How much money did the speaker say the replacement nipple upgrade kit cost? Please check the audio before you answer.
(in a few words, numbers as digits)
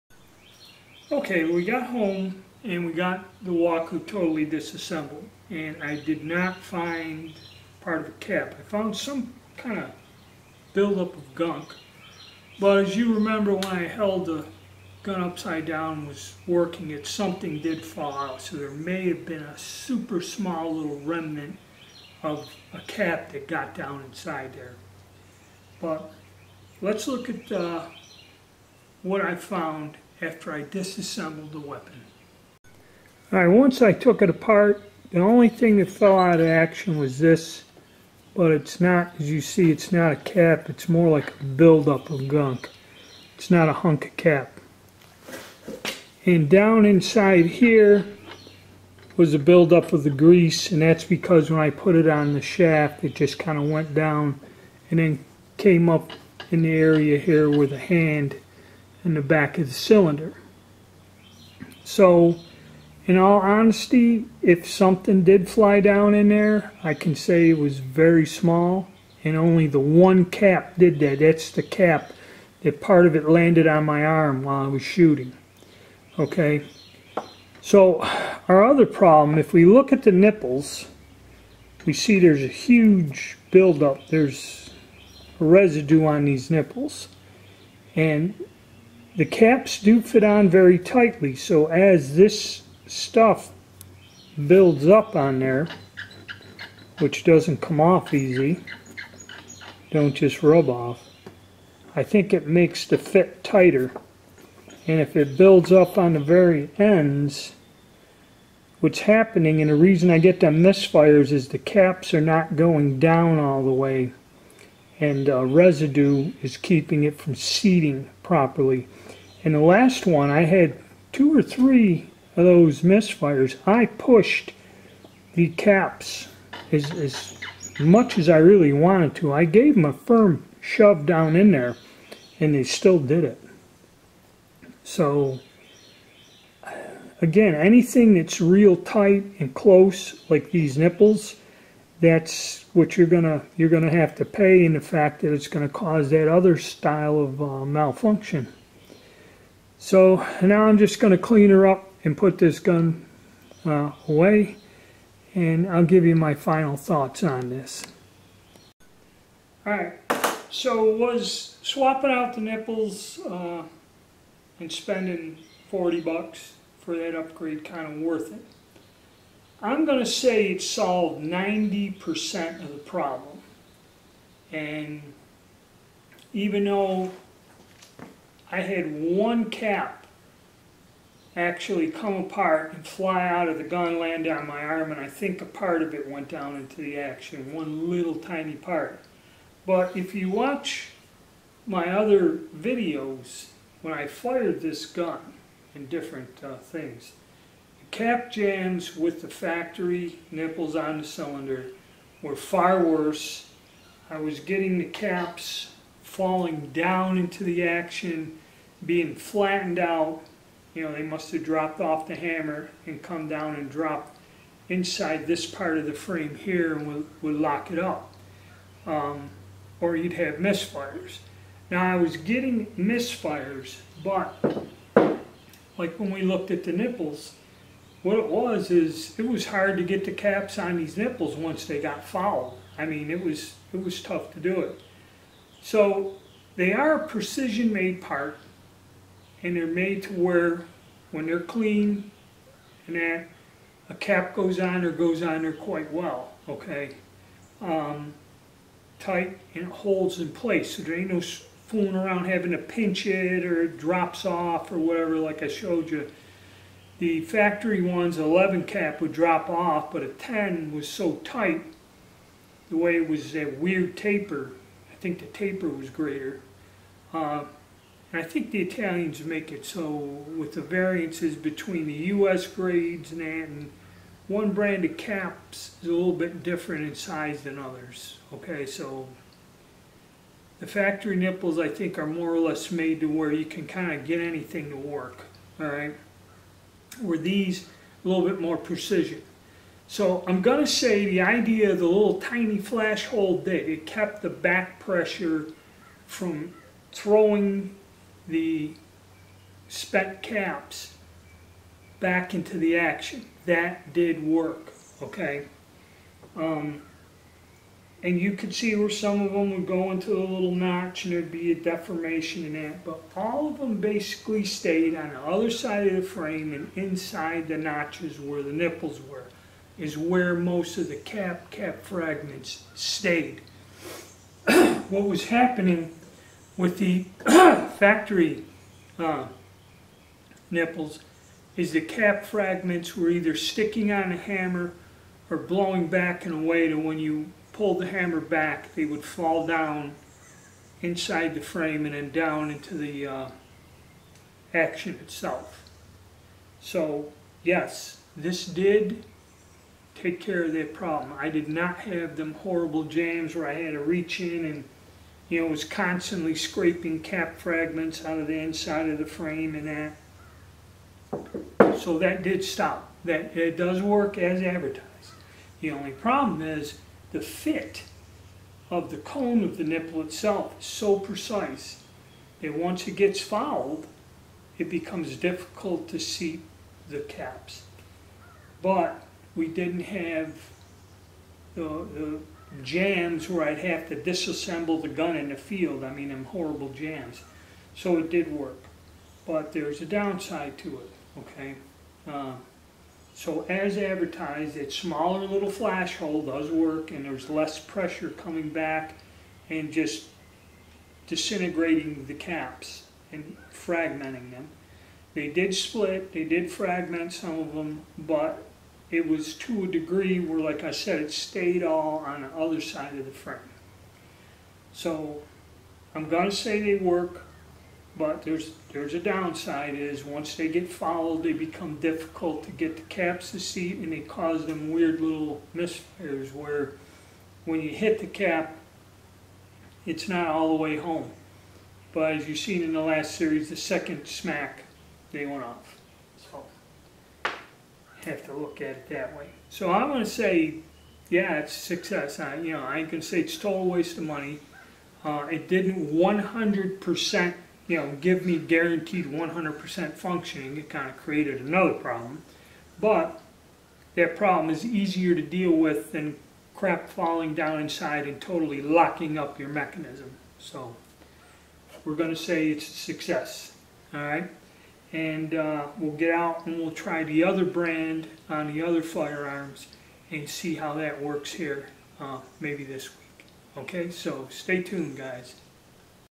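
$40.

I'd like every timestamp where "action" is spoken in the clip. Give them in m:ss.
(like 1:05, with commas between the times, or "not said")
0:36, 3:06, 3:27, 5:02, 5:44.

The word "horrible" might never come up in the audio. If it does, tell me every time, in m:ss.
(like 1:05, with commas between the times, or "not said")
5:52, 6:26.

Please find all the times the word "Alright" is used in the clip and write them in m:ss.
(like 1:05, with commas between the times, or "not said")
0:33, 2:39.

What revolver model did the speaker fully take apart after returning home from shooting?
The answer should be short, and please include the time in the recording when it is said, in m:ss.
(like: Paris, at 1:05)
Walker, at 0:03.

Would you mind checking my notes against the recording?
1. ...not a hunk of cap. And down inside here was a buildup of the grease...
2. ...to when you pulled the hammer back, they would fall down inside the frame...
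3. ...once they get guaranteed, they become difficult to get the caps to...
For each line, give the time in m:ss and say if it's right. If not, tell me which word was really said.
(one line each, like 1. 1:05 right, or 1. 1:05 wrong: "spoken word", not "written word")
1. 0:43 right
2. 5:36 right
3. 7:00 wrong: "fouled", not "guaranteed".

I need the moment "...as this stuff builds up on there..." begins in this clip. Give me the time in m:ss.
1:31.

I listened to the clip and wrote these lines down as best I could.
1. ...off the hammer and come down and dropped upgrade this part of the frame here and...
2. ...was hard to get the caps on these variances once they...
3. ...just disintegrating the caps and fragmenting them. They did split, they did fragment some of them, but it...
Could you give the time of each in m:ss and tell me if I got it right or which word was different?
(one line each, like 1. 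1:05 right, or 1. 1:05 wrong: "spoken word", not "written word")
1. 3:31 wrong: "inside", not "upgrade"
2. 3:49 wrong: "nipples", not "variances"
3. 6:39 right.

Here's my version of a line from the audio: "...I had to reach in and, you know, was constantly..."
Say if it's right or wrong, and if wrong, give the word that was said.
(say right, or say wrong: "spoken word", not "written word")
right.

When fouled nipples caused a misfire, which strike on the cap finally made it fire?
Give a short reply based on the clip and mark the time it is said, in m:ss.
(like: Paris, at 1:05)
The second smack, at 7:13.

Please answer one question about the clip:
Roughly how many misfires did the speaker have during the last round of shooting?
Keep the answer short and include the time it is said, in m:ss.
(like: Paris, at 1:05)
2 or 3, at 2:01.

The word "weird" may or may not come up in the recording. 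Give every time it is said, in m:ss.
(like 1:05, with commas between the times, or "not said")
4:23, 7:04.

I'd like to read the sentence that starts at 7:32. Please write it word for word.
But that problem is easier to deal with than crap falling down inside and totally locking up your mechanism.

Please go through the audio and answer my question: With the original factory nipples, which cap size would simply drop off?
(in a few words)
11.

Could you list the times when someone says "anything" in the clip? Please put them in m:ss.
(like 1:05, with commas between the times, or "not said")
2:17, 4:44.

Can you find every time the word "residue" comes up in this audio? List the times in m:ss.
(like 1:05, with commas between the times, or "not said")
1:25, 1:55.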